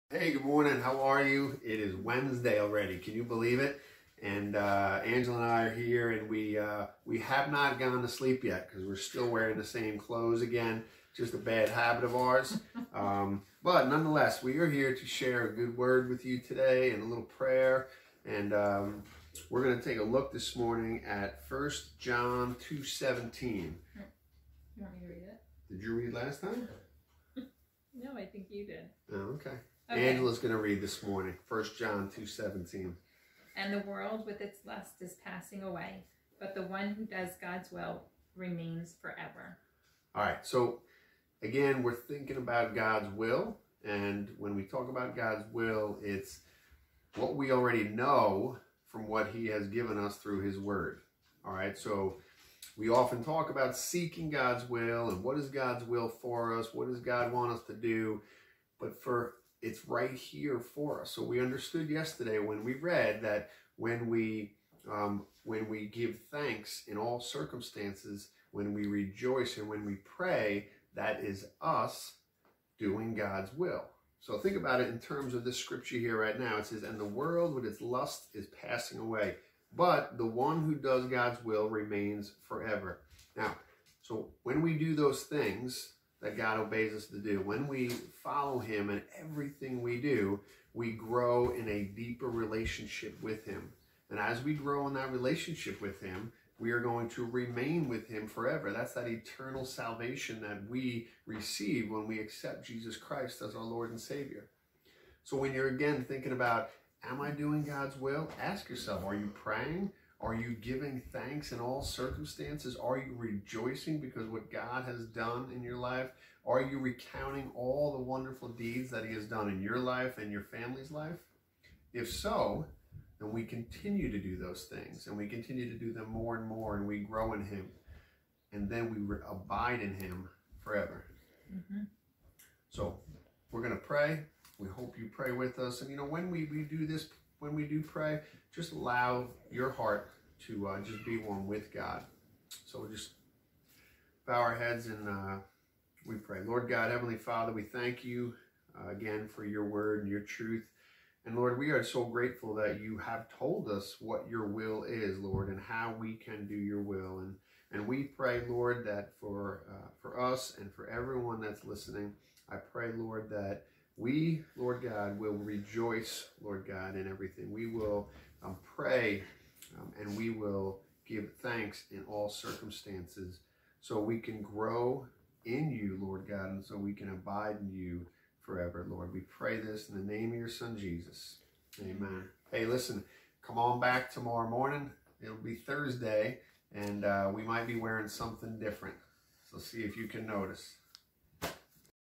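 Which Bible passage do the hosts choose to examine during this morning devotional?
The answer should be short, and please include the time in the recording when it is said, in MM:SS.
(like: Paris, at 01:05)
1 John 2:17, at 00:21.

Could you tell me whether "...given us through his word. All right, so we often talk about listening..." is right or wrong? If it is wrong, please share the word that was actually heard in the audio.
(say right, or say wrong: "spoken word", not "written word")
wrong: "seeking", not "listening".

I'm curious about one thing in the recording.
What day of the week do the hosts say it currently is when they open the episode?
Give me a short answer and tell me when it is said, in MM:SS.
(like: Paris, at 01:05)
Wednesday, at 00:01.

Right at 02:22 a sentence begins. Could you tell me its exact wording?
So we'll just bow our heads and uh, we pray.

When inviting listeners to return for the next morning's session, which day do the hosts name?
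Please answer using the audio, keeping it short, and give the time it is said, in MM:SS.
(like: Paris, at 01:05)
Thursday, at 03:05.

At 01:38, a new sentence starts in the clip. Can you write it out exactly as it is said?
That's that eternal salvation that we receive when we accept Jesus Christ as our Lord and Savior.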